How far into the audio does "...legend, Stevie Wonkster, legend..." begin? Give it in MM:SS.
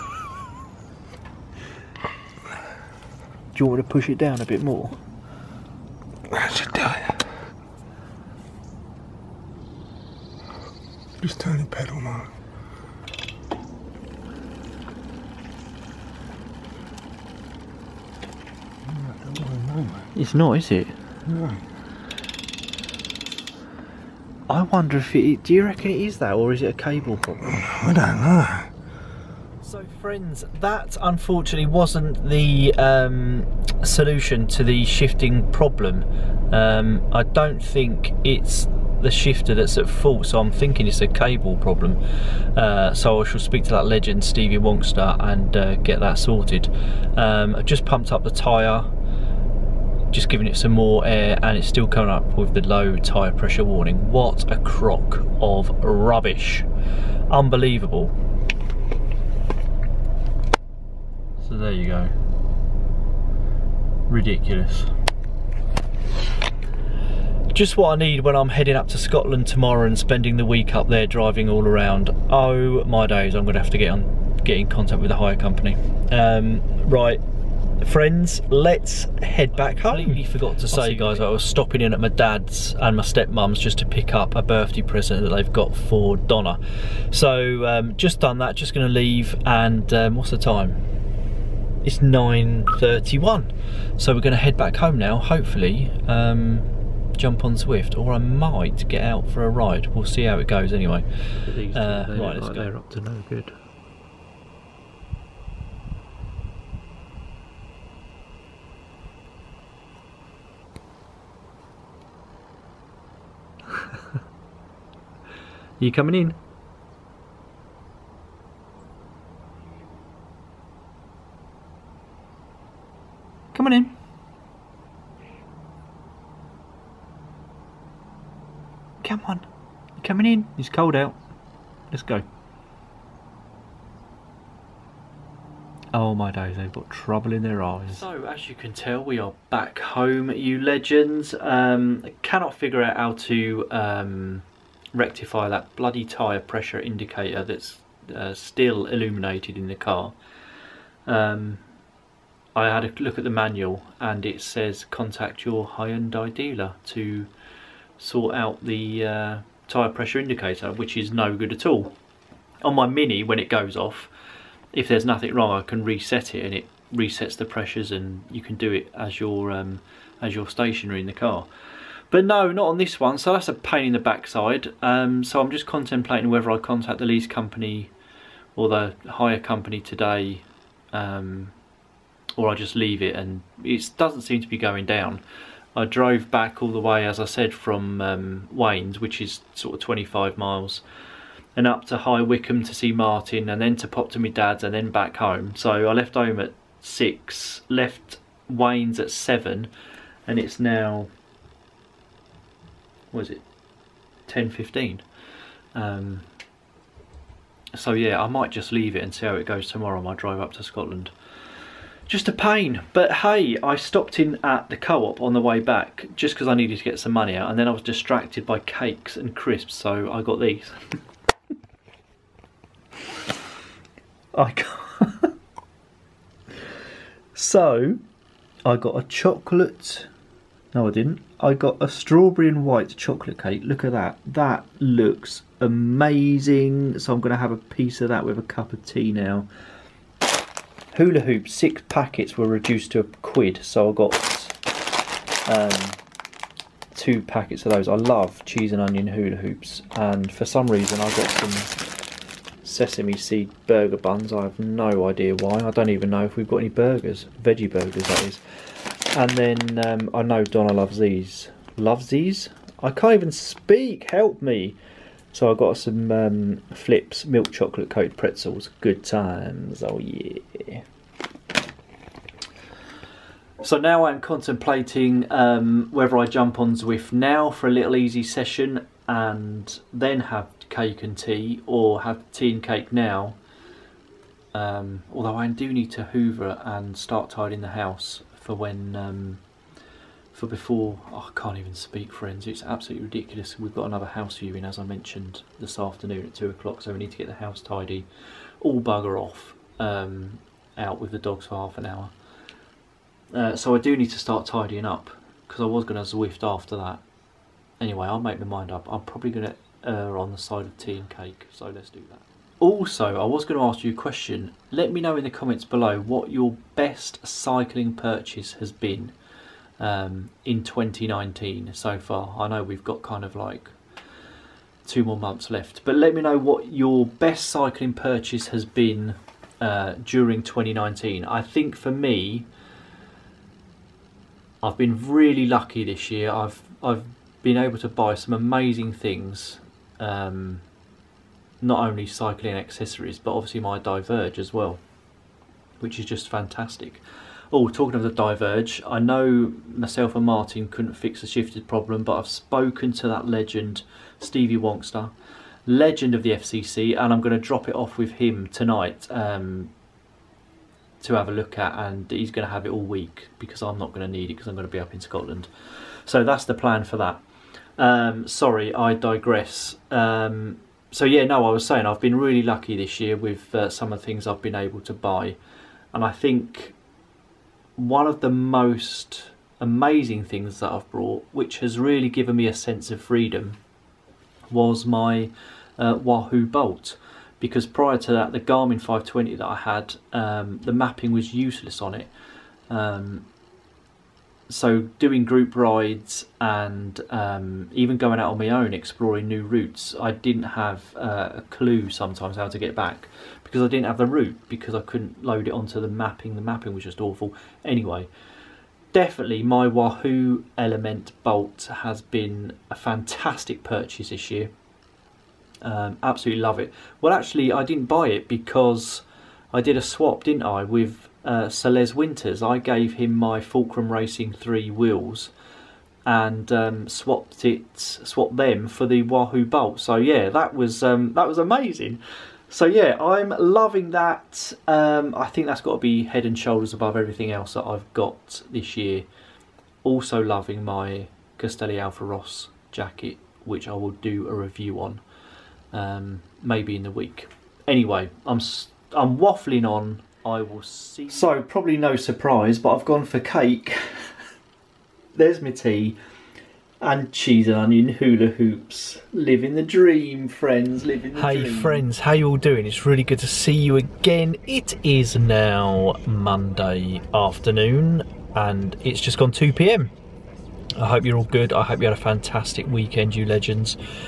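05:53.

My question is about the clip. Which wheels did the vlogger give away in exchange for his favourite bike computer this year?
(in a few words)
Fulcrum Racing 3.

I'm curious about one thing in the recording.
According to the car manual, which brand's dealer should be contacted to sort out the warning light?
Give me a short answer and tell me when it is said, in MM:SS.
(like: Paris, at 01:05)
Hyundai, at 02:35.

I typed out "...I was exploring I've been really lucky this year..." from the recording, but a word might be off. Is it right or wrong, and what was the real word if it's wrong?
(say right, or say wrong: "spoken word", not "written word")
wrong: "saying", not "exploring".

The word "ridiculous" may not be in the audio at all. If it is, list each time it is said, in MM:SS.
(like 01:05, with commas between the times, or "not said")
01:04, 04:53.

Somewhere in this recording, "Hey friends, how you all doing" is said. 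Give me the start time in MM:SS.
07:41.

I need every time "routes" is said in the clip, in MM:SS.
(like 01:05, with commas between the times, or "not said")
06:39, 06:44.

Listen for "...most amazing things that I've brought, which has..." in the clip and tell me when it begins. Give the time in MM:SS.
06:18.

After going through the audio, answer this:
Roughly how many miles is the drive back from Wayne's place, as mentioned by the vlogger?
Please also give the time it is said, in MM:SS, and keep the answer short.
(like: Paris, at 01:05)
25 miles, at 03:09.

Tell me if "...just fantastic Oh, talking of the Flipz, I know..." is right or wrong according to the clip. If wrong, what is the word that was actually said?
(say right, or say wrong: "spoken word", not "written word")
wrong: "Diverge", not "Flipz".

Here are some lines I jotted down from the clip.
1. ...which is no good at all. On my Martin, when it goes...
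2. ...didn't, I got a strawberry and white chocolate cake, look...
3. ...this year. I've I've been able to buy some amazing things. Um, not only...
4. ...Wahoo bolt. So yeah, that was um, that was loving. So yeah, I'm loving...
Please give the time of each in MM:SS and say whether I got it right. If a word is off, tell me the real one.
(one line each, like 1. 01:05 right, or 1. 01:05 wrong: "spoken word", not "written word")
1. 02:40 wrong: "Mini", not "Martin"
2. 03:50 right
3. 05:35 right
4. 07:09 wrong: "amazing", not "loving".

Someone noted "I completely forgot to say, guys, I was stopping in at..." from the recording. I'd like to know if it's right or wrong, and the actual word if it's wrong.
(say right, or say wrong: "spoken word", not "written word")
right.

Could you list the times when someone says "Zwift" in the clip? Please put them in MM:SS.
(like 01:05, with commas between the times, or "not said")
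01:37, 04:36, 05:06.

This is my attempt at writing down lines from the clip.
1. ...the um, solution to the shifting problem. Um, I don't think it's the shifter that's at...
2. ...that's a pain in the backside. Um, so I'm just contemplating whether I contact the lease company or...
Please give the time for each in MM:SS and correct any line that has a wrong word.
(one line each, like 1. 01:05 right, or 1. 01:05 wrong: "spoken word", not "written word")
1. 00:32 right
2. 02:53 right.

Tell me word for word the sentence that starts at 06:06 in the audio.
So that's the plan for that.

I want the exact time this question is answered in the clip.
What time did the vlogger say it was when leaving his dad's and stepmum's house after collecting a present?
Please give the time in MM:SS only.
01:31.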